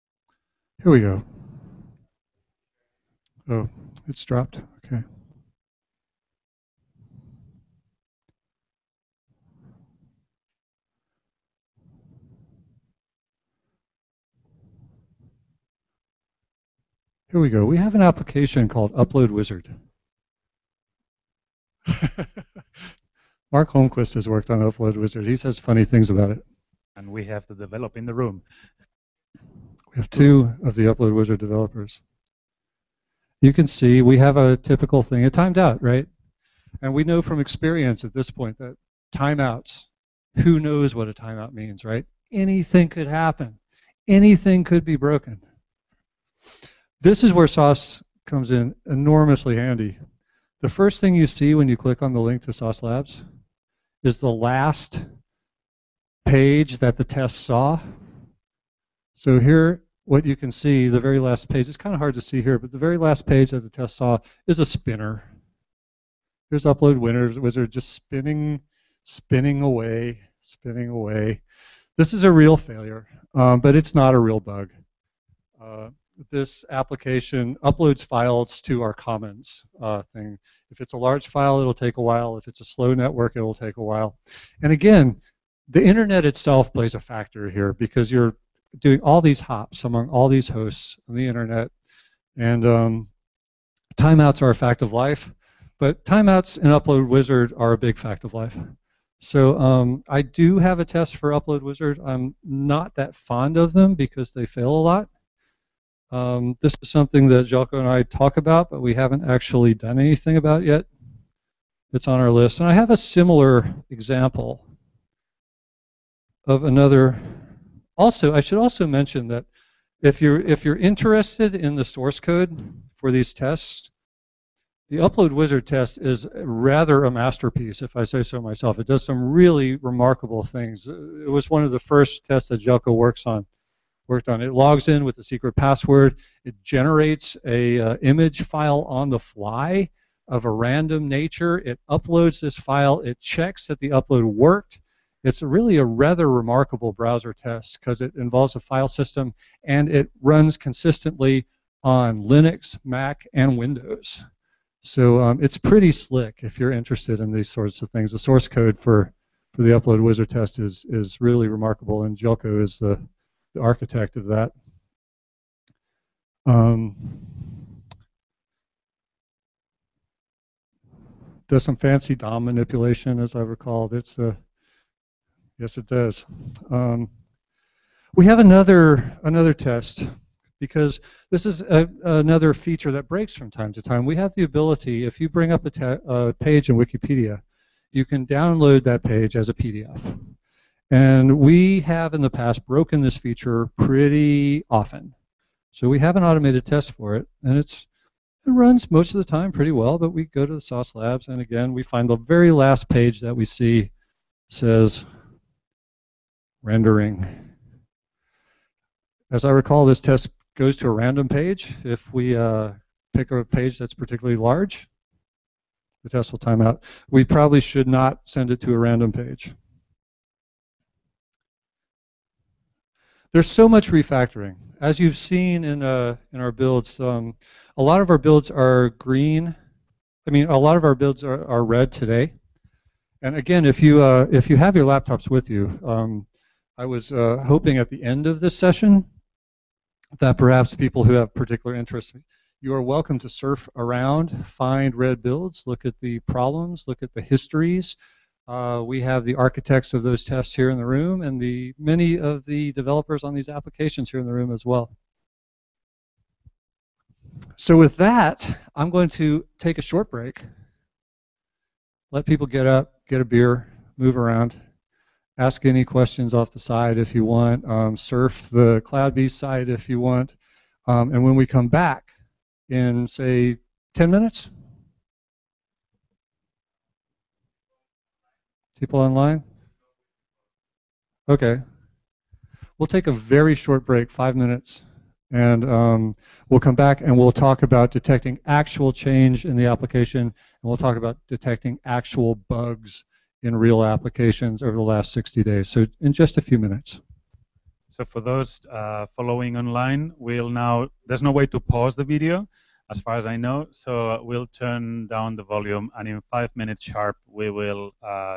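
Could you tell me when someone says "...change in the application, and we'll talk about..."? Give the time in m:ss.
4:48.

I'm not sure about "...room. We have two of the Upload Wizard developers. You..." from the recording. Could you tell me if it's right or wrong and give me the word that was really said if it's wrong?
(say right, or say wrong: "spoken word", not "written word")
right.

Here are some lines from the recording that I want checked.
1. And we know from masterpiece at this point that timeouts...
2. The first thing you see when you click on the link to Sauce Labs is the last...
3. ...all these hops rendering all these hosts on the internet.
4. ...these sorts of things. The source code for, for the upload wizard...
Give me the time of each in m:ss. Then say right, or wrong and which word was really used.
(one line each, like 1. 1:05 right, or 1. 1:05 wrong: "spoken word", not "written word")
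1. 0:36 wrong: "experience", not "masterpiece"
2. 0:50 right
3. 1:29 wrong: "among", not "rendering"
4. 2:37 right.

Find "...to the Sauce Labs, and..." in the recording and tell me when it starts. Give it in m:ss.
3:20.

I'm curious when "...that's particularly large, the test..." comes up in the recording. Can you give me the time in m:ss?
3:33.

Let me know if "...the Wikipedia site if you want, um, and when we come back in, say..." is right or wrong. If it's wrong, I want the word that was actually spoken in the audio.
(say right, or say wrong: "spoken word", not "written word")
wrong: "CloudBees", not "Wikipedia".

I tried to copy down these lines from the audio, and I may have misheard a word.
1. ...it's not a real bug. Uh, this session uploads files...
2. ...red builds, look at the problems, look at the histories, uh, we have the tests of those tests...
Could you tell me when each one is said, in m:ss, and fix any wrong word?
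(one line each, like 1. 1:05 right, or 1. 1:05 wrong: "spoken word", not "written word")
1. 1:13 wrong: "application", not "session"
2. 4:04 wrong: "architects", not "tests".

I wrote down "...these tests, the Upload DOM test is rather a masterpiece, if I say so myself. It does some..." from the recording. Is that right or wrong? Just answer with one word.
wrong.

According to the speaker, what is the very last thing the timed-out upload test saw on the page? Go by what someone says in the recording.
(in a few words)
A spinner.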